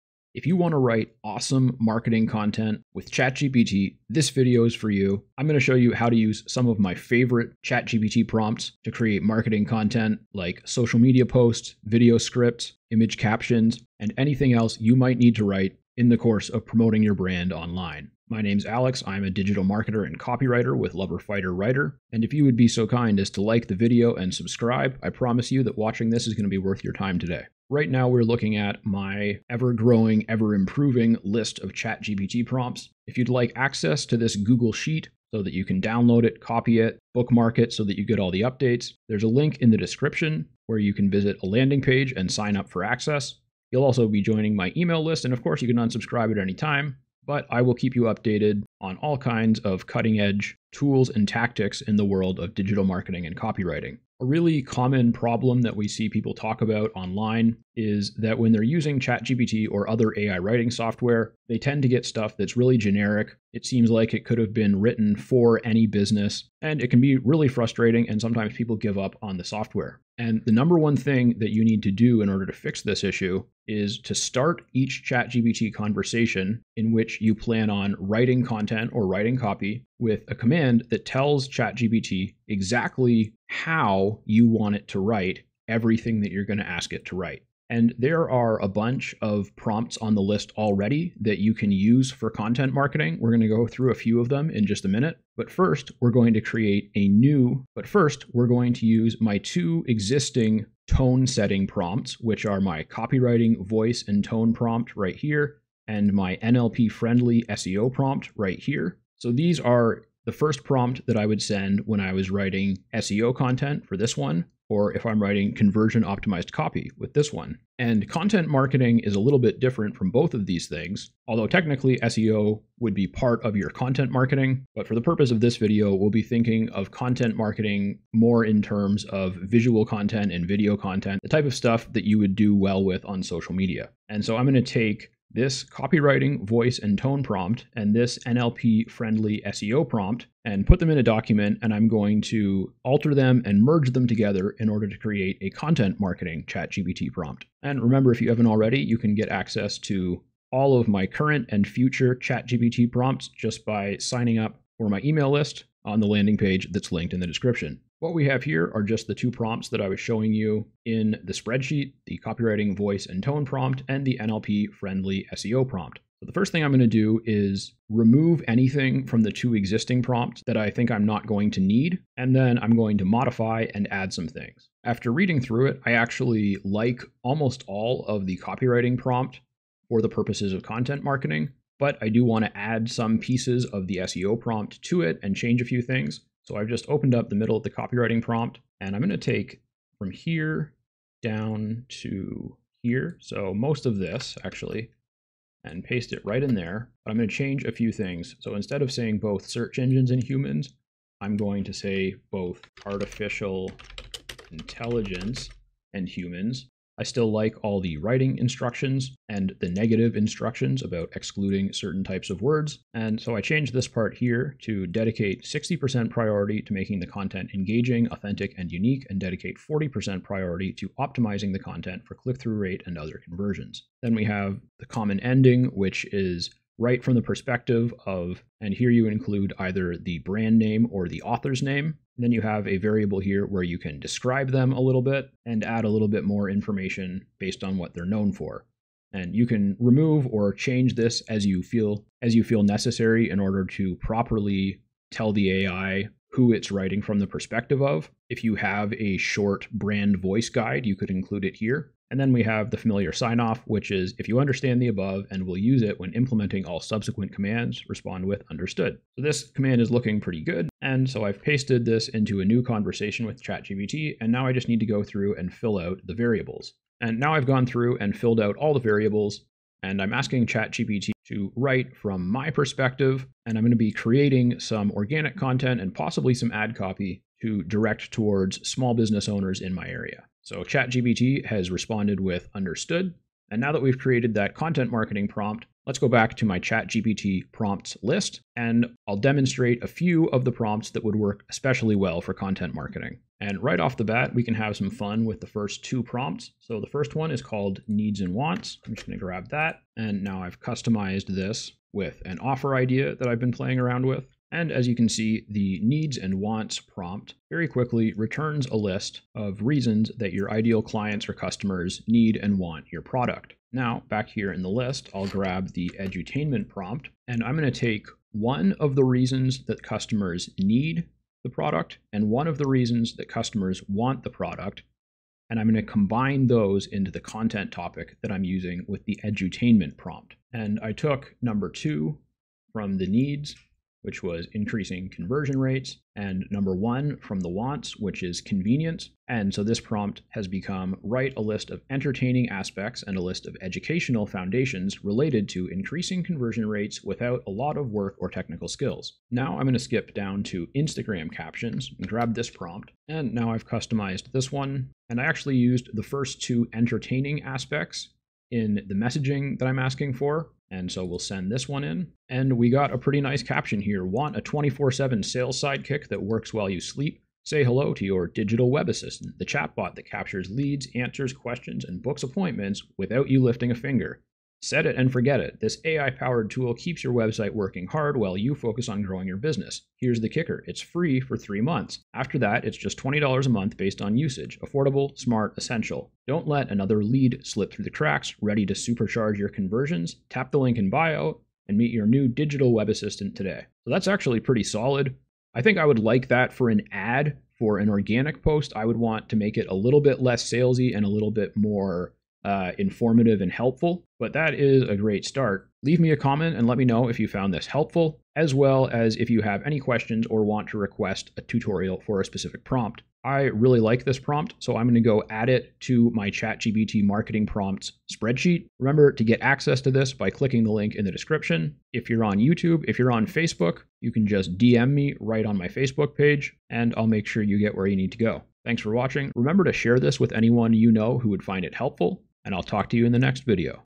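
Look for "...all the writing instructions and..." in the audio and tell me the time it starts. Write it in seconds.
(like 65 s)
207 s.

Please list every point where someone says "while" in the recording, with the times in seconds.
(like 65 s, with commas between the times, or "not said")
366 s, 378 s.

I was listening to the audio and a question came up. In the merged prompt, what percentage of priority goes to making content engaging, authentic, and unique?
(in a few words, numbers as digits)
60%.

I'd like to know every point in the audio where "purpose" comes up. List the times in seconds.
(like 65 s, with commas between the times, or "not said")
125 s, 180 s.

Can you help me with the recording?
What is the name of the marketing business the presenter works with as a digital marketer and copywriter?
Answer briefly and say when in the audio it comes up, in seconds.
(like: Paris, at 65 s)
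Lover Fighter Writer, at 20 s.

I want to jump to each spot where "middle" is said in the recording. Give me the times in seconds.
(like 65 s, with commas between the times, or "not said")
187 s.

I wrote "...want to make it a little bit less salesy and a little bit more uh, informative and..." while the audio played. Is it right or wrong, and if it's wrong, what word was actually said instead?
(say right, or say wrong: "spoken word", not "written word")
right.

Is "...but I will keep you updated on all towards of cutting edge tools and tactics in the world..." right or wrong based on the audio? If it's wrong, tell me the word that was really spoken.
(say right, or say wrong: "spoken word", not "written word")
wrong: "kinds", not "towards".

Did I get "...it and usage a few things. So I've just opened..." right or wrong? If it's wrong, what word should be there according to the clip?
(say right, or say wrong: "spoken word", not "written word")
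wrong: "change", not "usage".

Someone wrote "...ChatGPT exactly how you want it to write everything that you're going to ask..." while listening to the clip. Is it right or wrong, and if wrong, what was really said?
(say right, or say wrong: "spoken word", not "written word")
right.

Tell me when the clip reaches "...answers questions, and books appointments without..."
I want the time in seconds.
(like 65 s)
370 s.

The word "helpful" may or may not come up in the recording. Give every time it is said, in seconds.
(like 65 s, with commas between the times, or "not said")
403 s, 407 s, 431 s.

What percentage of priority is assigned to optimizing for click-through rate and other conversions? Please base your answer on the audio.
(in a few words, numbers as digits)
40%.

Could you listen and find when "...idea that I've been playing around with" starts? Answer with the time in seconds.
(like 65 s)
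302 s.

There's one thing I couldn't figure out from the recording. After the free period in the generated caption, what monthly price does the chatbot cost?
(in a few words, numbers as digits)
$20.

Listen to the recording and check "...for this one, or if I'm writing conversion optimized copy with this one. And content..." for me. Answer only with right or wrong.
right.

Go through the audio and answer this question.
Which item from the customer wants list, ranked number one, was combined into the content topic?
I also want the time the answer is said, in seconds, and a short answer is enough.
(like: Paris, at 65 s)
convenience, at 338 s.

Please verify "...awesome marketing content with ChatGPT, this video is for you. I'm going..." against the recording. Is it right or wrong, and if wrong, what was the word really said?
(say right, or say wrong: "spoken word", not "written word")
right.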